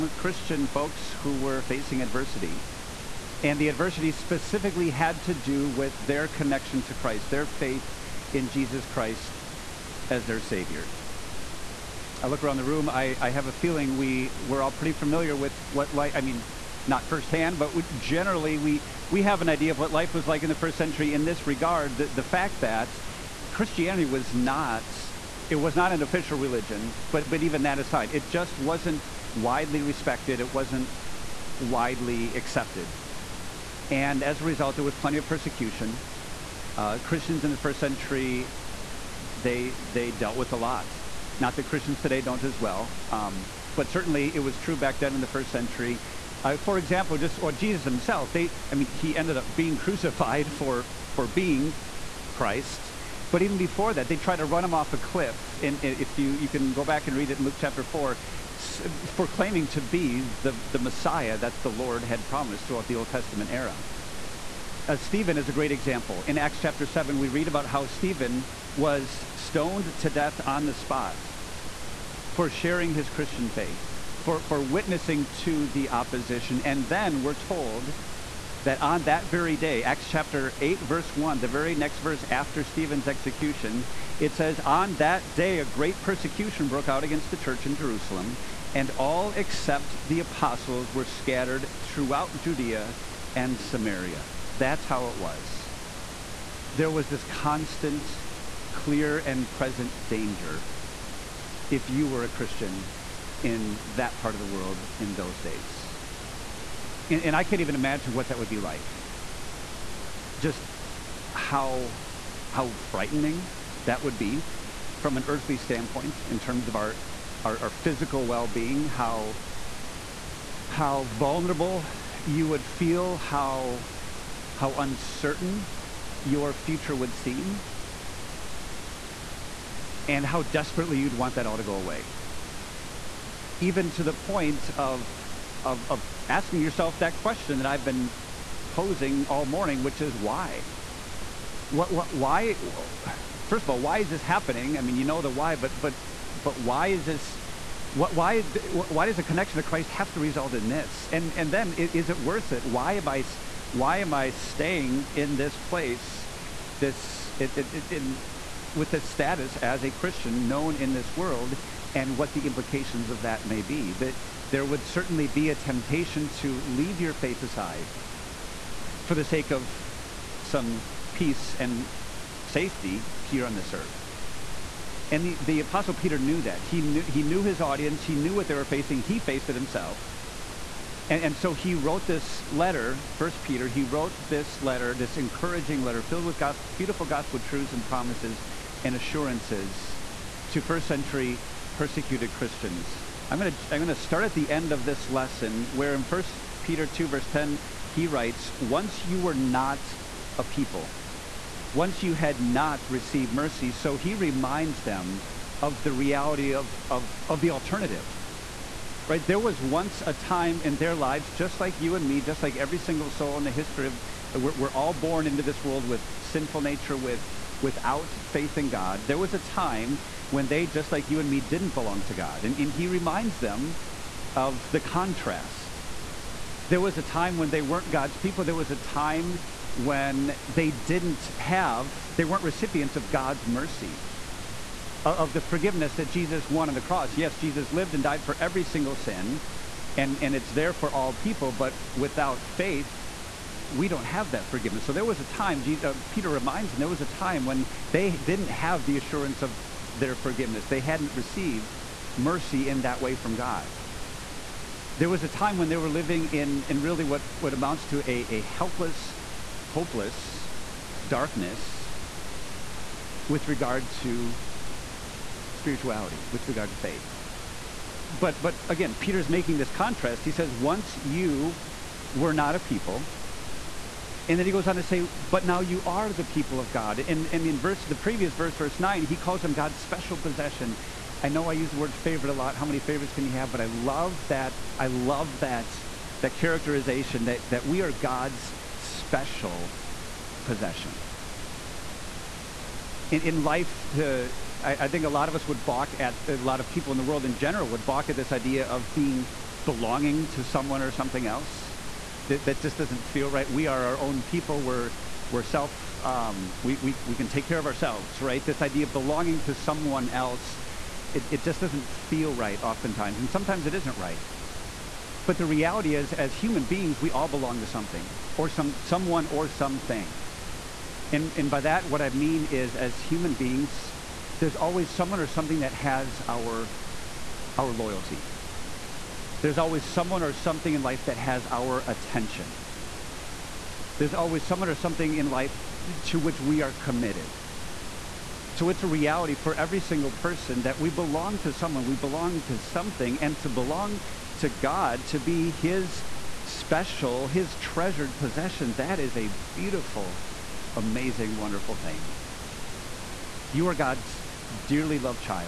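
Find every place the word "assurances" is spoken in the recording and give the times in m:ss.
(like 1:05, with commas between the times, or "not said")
3:08, 4:08.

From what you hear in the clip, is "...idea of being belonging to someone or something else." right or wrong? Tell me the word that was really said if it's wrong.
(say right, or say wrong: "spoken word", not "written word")
right.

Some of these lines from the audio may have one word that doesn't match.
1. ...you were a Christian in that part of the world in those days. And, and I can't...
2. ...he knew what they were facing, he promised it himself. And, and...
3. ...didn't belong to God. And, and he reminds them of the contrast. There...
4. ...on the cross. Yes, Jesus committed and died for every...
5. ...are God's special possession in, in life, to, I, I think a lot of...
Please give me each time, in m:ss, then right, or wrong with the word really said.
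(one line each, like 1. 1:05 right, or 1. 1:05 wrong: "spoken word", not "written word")
1. 1:41 right
2. 2:58 wrong: "faced", not "promised"
3. 3:41 right
4. 3:56 wrong: "lived", not "committed"
5. 4:47 right.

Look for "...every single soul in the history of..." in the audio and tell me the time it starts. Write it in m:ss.
3:32.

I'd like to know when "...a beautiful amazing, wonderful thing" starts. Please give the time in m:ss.
5:49.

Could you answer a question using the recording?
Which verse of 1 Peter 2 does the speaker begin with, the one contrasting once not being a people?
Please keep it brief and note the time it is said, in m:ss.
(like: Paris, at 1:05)
Verse 10, at 3:17.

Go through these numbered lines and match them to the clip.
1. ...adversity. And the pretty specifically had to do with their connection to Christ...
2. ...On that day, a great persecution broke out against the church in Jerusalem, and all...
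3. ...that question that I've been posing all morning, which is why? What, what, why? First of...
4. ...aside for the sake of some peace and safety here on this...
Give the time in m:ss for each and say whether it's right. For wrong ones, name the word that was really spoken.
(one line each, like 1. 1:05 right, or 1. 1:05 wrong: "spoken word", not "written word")
1. 0:02 wrong: "adversity", not "pretty"
2. 1:24 right
3. 2:16 right
4. 2:47 right.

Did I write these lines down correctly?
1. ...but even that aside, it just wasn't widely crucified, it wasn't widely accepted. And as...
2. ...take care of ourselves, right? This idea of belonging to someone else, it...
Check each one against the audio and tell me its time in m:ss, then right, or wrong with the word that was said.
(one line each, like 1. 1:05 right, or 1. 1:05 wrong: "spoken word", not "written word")
1. 0:27 wrong: "respected", not "crucified"
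2. 5:07 right.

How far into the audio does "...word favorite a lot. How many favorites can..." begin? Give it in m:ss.
4:41.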